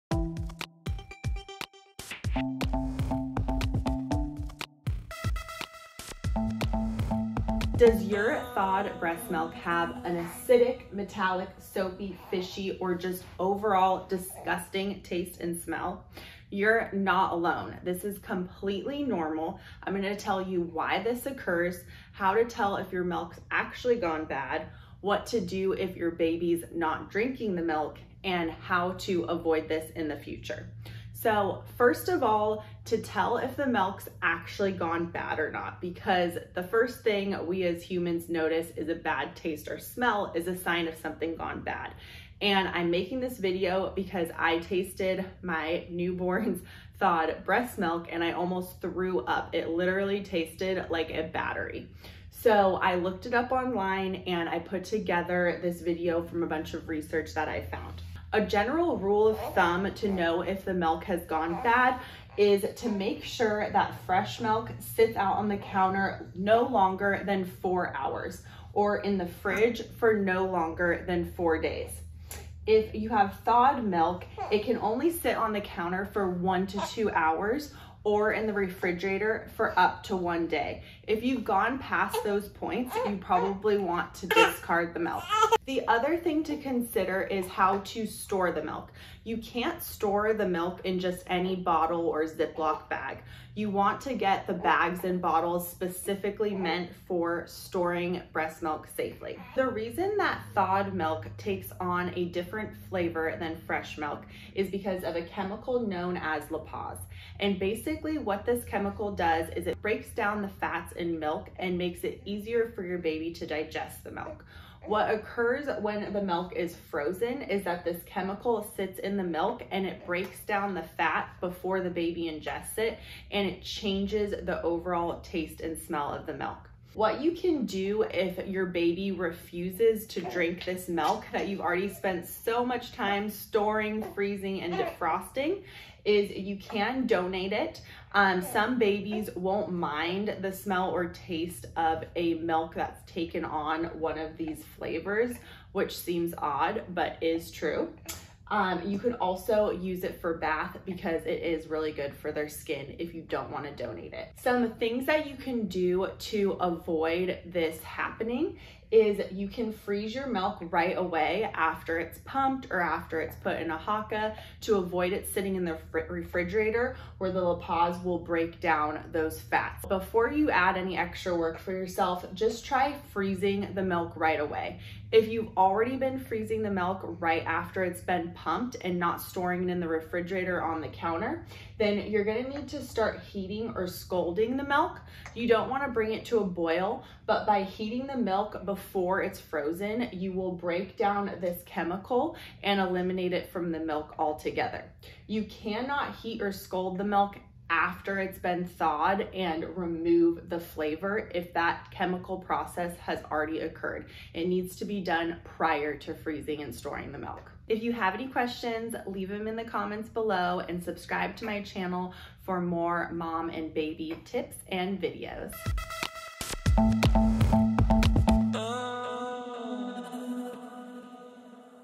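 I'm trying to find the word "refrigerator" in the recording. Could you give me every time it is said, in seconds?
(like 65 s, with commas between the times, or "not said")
78 s, 166 s, 179 s.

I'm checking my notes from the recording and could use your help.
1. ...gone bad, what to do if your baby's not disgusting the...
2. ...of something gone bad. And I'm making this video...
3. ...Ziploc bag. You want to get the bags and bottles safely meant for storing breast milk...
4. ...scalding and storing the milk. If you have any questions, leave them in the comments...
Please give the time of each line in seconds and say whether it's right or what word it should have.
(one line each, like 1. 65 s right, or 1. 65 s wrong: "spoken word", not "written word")
1. 23 s wrong: "drinking", not "disgusting"
2. 40 s right
3. 92 s wrong: "specifically", not "safely"
4. 206 s wrong: "freezing", not "scalding".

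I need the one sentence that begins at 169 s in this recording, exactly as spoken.
Before you add any extra work for yourself, just try freezing the milk right away.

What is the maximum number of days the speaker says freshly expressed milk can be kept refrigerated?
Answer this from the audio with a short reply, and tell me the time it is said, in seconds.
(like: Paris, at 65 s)
4 days, at 71 s.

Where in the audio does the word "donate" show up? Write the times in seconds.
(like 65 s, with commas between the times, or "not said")
137 s, 153 s.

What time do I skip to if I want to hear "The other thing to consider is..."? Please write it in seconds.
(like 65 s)
85 s.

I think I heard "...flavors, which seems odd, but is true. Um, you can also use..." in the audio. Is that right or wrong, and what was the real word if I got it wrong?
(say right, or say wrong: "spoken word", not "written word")
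right.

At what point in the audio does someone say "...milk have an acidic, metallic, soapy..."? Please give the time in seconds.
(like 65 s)
9 s.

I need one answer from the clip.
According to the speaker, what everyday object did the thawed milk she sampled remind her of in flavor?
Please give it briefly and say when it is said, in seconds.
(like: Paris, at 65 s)
A battery, at 51 s.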